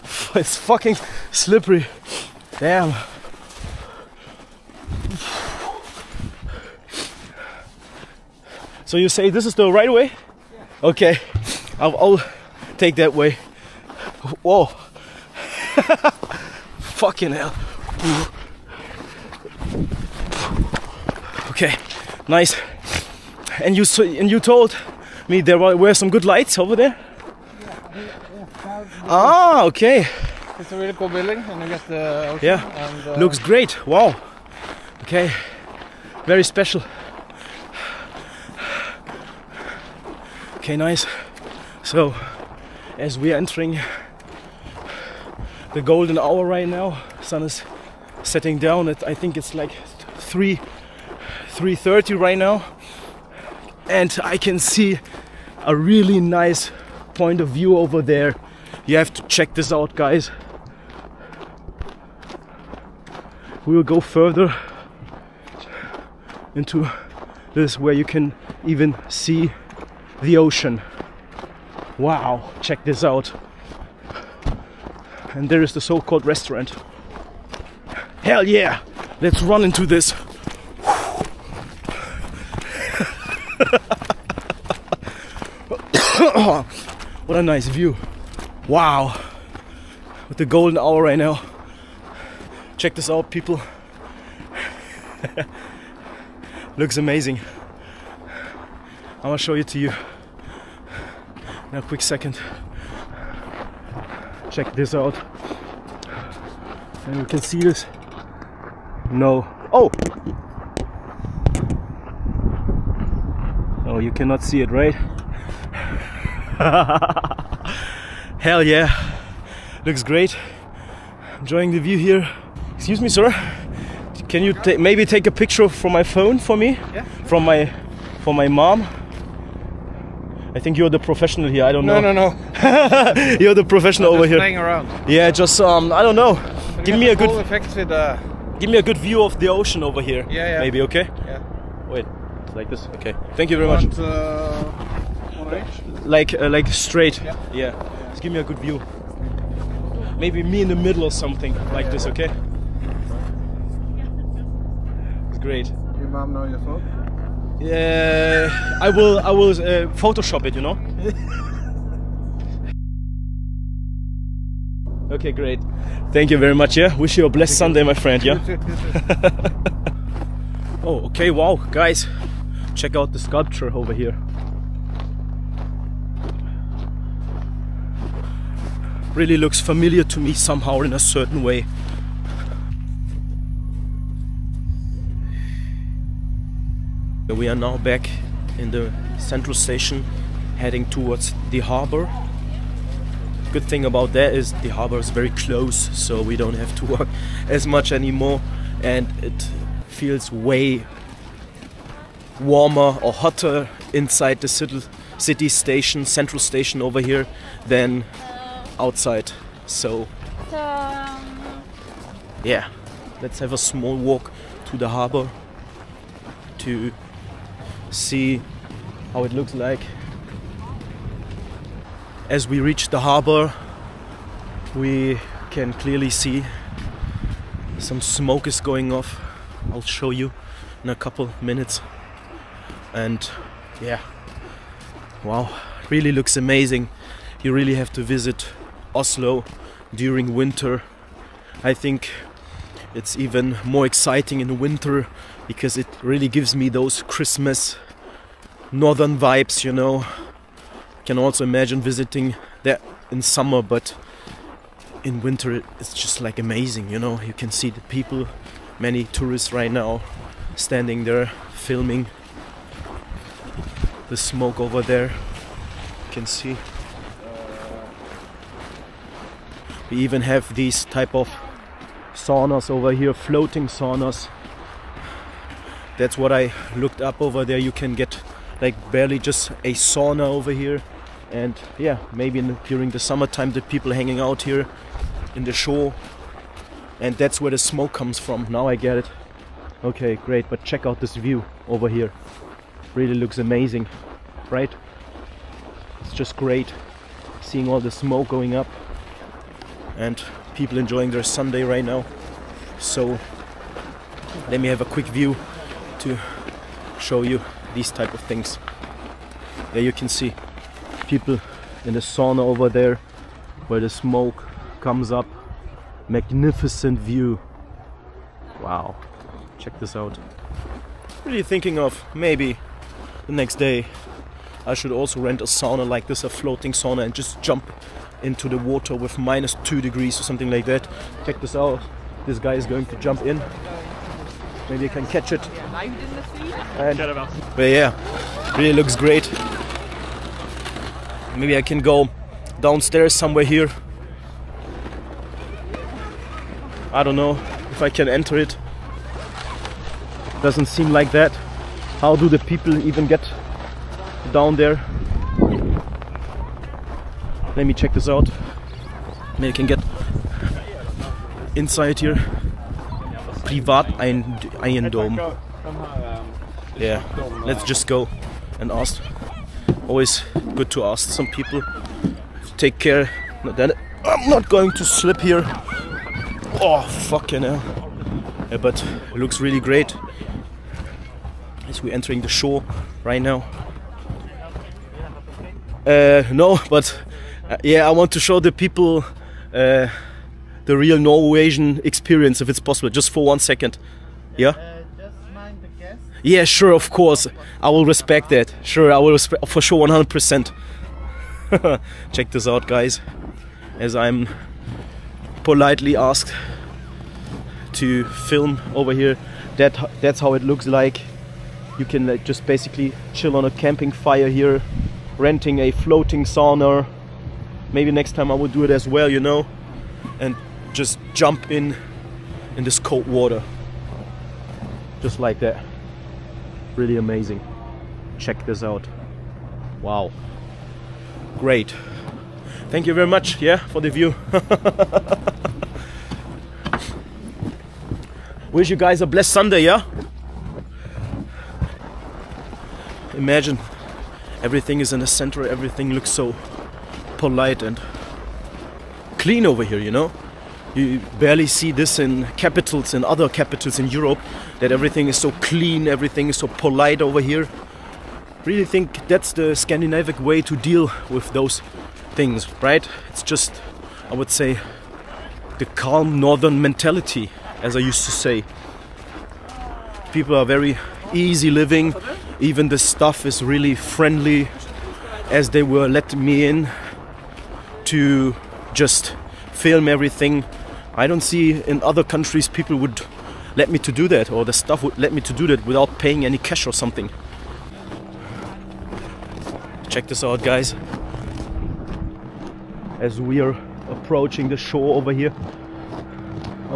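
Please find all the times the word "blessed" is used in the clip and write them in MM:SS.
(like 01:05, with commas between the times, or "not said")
02:47, 07:19.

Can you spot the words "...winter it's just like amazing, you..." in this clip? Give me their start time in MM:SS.
04:15.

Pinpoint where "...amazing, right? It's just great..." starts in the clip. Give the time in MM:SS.
04:53.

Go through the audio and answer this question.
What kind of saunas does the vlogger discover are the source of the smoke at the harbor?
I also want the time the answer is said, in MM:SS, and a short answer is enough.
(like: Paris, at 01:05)
floating saunas, at 04:33.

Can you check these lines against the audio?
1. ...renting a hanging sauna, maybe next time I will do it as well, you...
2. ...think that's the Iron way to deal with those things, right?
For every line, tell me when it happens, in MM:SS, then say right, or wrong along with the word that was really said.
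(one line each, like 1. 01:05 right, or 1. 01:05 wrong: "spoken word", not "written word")
1. 06:55 wrong: "floating", not "hanging"
2. 07:38 wrong: "Scandinavian", not "Iron".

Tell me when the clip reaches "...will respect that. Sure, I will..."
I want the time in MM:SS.
06:37.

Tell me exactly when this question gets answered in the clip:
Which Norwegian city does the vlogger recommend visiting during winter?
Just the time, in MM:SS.
03:58.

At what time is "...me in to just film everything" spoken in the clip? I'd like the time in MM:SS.
07:56.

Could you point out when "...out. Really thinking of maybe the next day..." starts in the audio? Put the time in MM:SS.
05:19.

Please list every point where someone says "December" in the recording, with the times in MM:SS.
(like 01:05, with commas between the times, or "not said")
not said.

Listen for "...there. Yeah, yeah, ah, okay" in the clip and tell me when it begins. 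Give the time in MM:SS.
00:26.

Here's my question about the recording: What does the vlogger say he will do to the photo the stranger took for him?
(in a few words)
Photoshop it.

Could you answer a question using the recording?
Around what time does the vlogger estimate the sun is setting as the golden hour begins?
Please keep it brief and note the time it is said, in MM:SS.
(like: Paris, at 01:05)
3:30, at 00:50.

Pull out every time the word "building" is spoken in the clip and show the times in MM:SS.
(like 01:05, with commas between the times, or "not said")
00:31.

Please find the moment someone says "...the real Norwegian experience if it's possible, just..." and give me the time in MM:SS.
06:30.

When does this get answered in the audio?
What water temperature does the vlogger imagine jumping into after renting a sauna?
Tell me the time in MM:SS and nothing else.
05:29.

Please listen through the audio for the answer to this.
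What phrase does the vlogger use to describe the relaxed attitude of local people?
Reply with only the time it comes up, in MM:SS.
07:45.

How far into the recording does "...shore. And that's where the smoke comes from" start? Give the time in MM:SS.
04:45.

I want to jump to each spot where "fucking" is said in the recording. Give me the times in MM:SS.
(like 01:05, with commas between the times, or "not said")
00:00, 00:16, 06:17.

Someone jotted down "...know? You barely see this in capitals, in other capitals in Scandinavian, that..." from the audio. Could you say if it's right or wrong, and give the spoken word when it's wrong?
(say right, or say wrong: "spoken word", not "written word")
wrong: "Europe", not "Scandinavian".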